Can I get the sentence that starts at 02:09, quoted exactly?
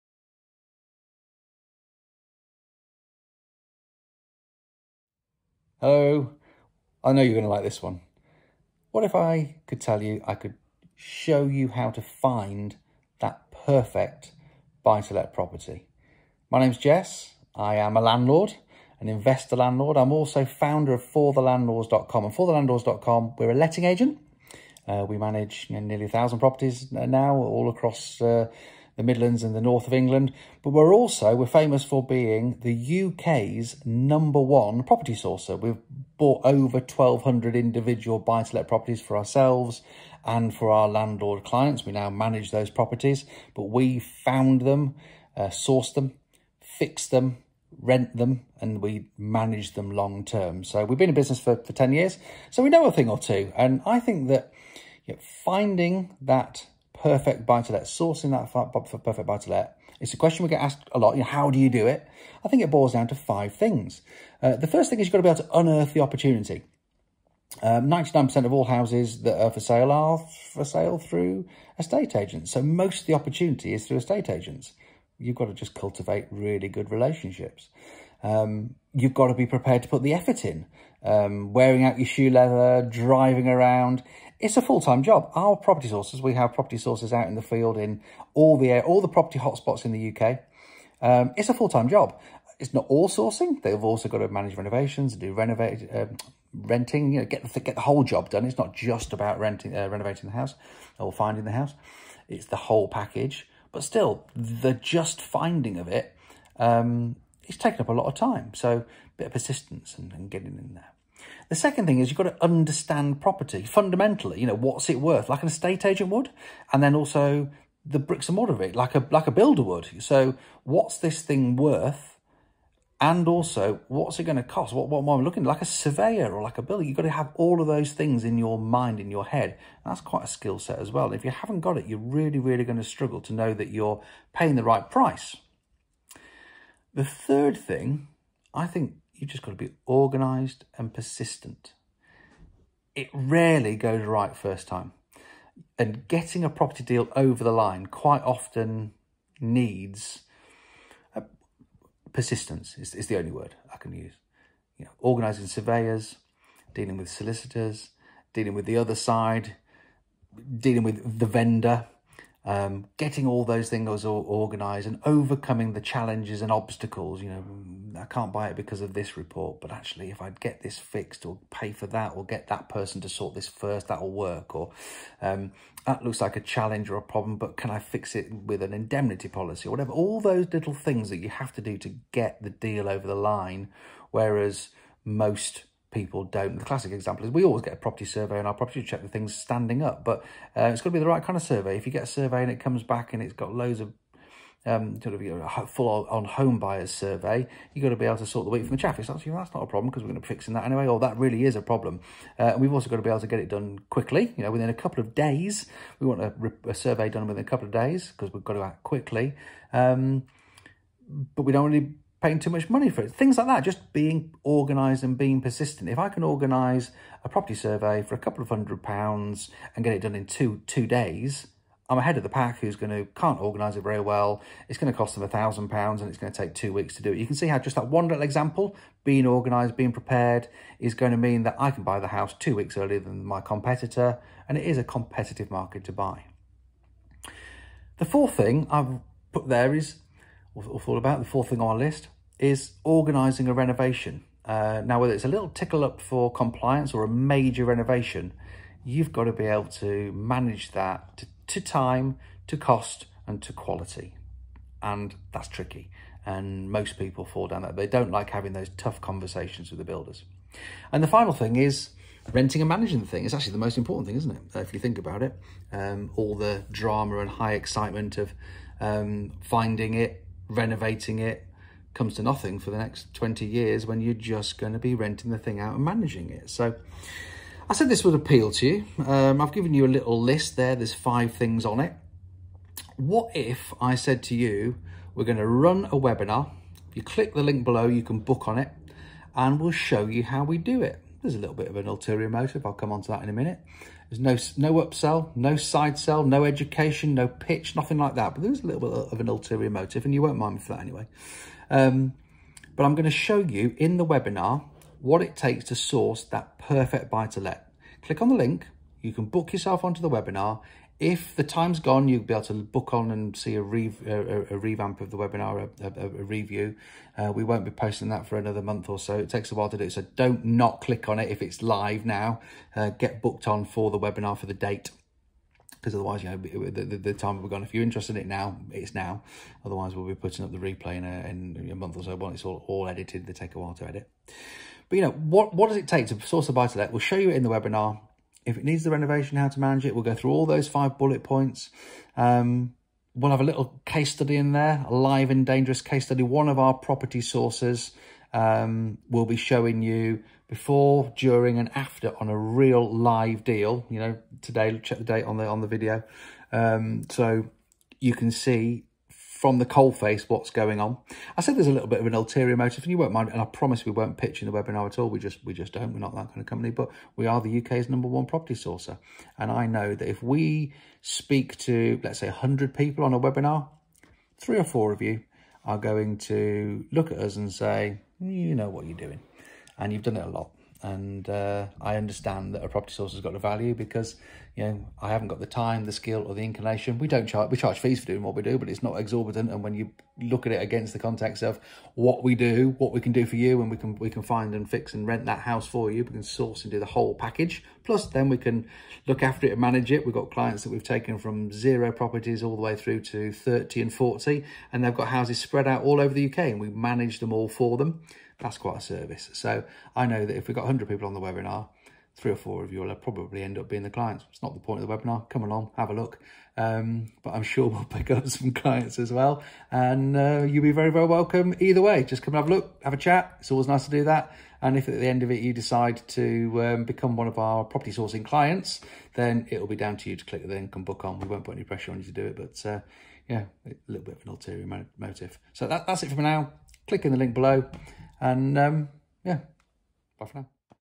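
And that's quite a skill set as well.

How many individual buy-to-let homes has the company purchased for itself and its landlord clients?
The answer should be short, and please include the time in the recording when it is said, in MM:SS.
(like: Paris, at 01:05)
over 1,200, at 00:36.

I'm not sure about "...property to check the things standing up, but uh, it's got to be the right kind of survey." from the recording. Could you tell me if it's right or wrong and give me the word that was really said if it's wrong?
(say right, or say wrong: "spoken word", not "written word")
right.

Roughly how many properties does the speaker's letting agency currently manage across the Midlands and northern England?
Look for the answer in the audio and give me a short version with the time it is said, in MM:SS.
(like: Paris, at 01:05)
nearly 1,000, at 00:25.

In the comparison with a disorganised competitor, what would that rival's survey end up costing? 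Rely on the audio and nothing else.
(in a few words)
a thousand pounds.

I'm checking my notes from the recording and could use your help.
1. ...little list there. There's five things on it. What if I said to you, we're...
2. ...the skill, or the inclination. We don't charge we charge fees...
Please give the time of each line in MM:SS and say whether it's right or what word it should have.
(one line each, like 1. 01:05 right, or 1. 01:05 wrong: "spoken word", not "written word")
1. 04:39 right
2. 06:25 right.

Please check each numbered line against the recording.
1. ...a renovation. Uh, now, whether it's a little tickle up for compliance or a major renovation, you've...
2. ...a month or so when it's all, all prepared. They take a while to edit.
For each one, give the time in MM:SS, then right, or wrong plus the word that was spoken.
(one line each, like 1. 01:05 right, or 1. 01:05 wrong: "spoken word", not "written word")
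1. 04:03 right
2. 05:31 wrong: "edited", not "prepared".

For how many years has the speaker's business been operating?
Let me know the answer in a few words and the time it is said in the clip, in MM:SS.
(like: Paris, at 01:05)
10 years, at 00:51.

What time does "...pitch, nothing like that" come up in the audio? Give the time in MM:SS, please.
04:57.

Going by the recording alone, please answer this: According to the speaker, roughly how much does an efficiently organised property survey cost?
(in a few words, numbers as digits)
a couple of hundred pounds.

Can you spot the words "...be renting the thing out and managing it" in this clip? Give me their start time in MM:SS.
04:34.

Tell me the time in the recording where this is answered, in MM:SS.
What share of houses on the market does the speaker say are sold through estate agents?
01:07.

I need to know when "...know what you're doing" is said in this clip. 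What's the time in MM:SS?
06:18.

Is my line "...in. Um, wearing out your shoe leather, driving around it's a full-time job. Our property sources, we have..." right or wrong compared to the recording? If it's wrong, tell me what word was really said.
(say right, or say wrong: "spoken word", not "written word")
right.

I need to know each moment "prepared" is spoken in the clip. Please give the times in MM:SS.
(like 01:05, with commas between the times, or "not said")
01:19, 03:49.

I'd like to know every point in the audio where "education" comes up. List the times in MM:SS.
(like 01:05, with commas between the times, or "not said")
04:56.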